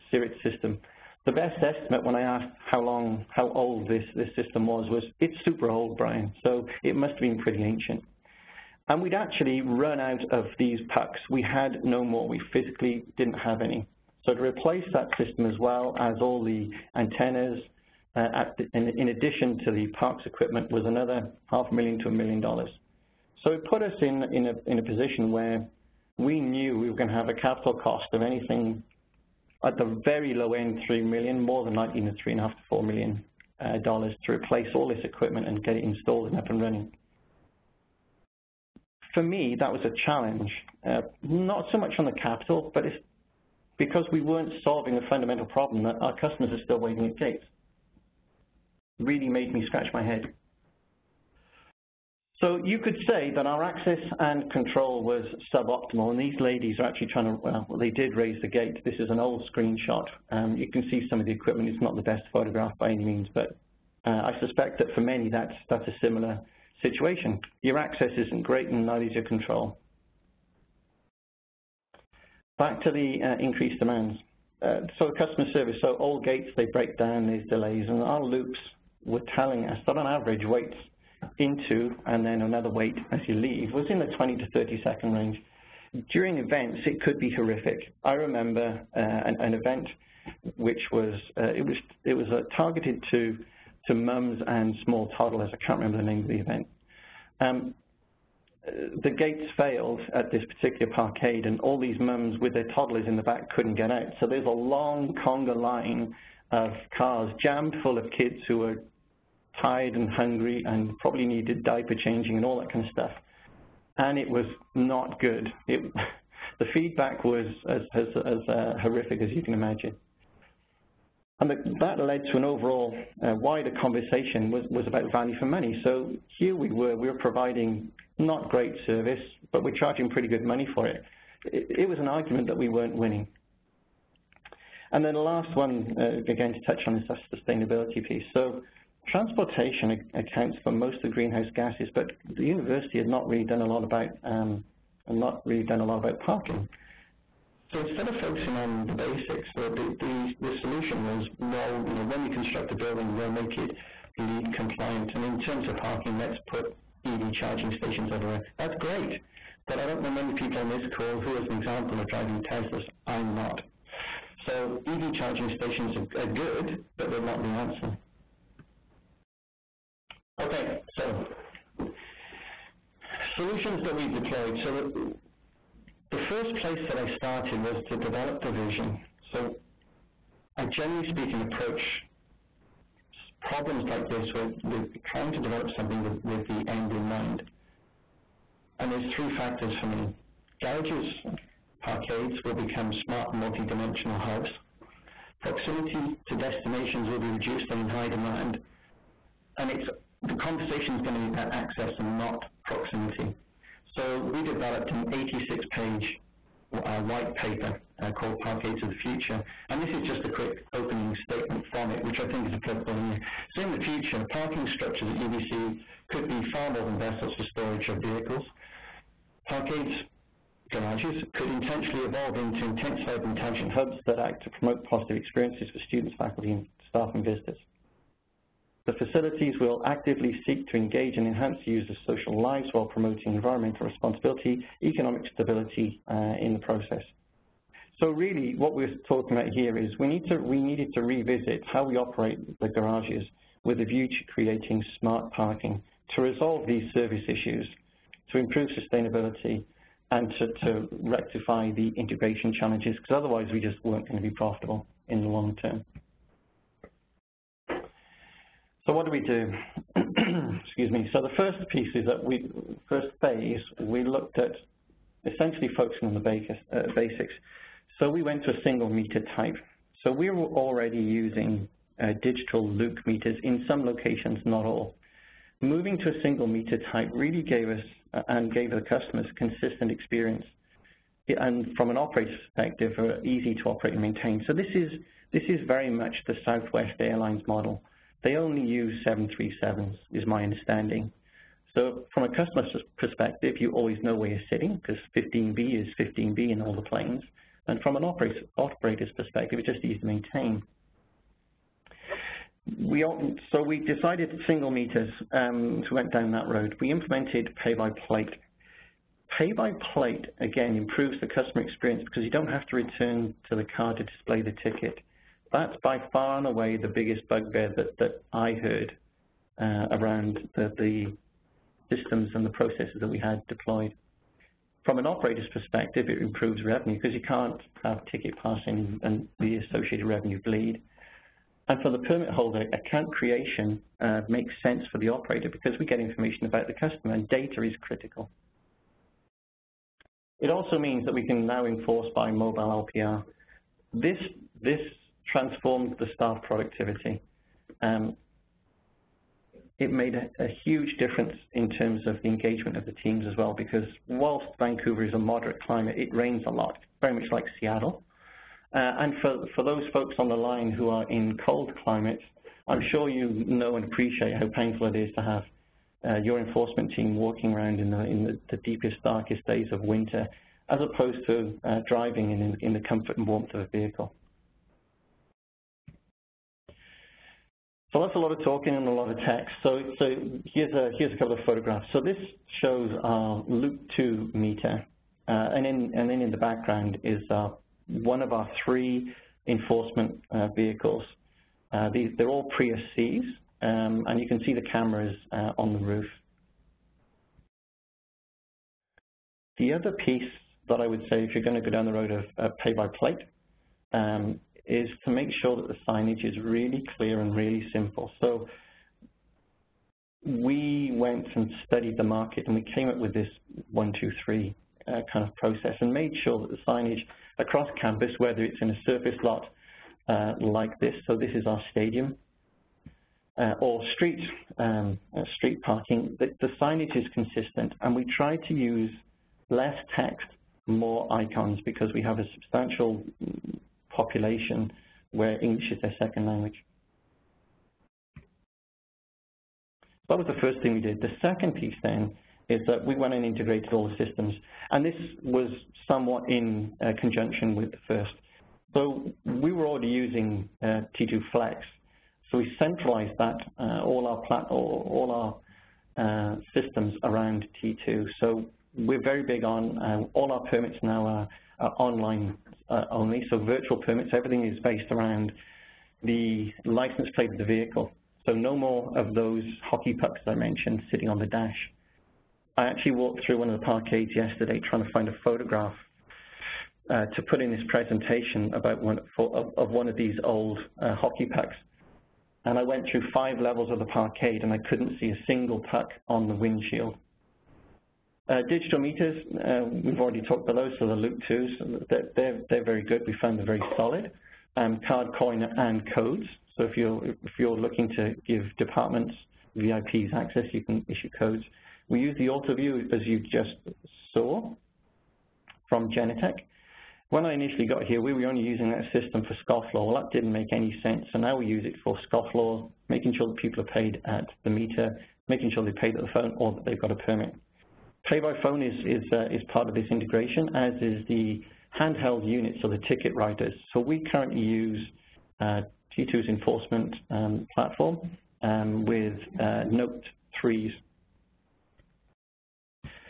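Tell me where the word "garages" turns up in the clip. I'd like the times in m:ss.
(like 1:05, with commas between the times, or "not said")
3:10, 3:40, 4:02.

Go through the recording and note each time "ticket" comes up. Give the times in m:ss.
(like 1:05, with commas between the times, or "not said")
5:14, 5:28, 8:42.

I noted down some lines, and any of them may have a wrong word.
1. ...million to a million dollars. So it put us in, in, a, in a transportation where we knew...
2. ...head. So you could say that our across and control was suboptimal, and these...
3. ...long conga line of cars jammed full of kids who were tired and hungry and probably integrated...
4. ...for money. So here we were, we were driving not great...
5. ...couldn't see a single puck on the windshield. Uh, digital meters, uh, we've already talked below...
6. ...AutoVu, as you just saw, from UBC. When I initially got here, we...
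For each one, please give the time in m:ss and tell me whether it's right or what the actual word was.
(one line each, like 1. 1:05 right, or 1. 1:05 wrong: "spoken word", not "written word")
1. 0:21 wrong: "position", not "transportation"
2. 0:50 wrong: "access", not "across"
3. 1:44 wrong: "needed", not "integrated"
4. 2:05 wrong: "providing", not "driving"
5. 8:04 right
6. 8:22 wrong: "Genetec", not "UBC".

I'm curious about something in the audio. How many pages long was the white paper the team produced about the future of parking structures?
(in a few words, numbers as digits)
86.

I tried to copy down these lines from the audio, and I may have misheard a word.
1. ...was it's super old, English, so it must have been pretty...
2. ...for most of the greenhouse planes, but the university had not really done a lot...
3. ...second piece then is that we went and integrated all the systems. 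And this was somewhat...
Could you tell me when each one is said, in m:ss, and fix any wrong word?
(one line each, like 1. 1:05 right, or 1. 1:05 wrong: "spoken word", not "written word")
1. 0:04 wrong: "Brian", not "English"
2. 2:20 wrong: "gases", not "planes"
3. 7:21 right.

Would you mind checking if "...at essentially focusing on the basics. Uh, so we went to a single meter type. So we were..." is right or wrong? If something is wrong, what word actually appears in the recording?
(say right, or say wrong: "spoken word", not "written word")
right.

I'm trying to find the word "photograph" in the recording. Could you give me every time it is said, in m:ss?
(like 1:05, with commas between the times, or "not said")
1:02, 6:21, 7:55.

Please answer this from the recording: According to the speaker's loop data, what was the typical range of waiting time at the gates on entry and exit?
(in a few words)
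20 to 30 seconds.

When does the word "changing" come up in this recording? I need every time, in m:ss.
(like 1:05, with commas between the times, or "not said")
1:52.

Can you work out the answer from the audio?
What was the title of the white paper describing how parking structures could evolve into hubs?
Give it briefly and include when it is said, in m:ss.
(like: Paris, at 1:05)
Parkades of the Future, at 3:28.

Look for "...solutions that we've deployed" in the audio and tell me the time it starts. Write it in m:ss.
2:53.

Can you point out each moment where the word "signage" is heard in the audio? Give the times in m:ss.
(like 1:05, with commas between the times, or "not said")
6:45, 6:56, 7:06.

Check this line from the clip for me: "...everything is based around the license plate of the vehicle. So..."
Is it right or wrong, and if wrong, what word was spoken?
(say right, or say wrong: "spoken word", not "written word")
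right.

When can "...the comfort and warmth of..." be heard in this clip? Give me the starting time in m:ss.
6:12.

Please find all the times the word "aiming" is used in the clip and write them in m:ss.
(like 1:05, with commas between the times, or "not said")
not said.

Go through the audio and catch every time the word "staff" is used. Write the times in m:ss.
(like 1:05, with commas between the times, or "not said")
3:46, 5:46.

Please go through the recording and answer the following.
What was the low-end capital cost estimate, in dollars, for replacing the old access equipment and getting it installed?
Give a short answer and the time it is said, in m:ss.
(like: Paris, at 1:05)
3 million, at 0:30.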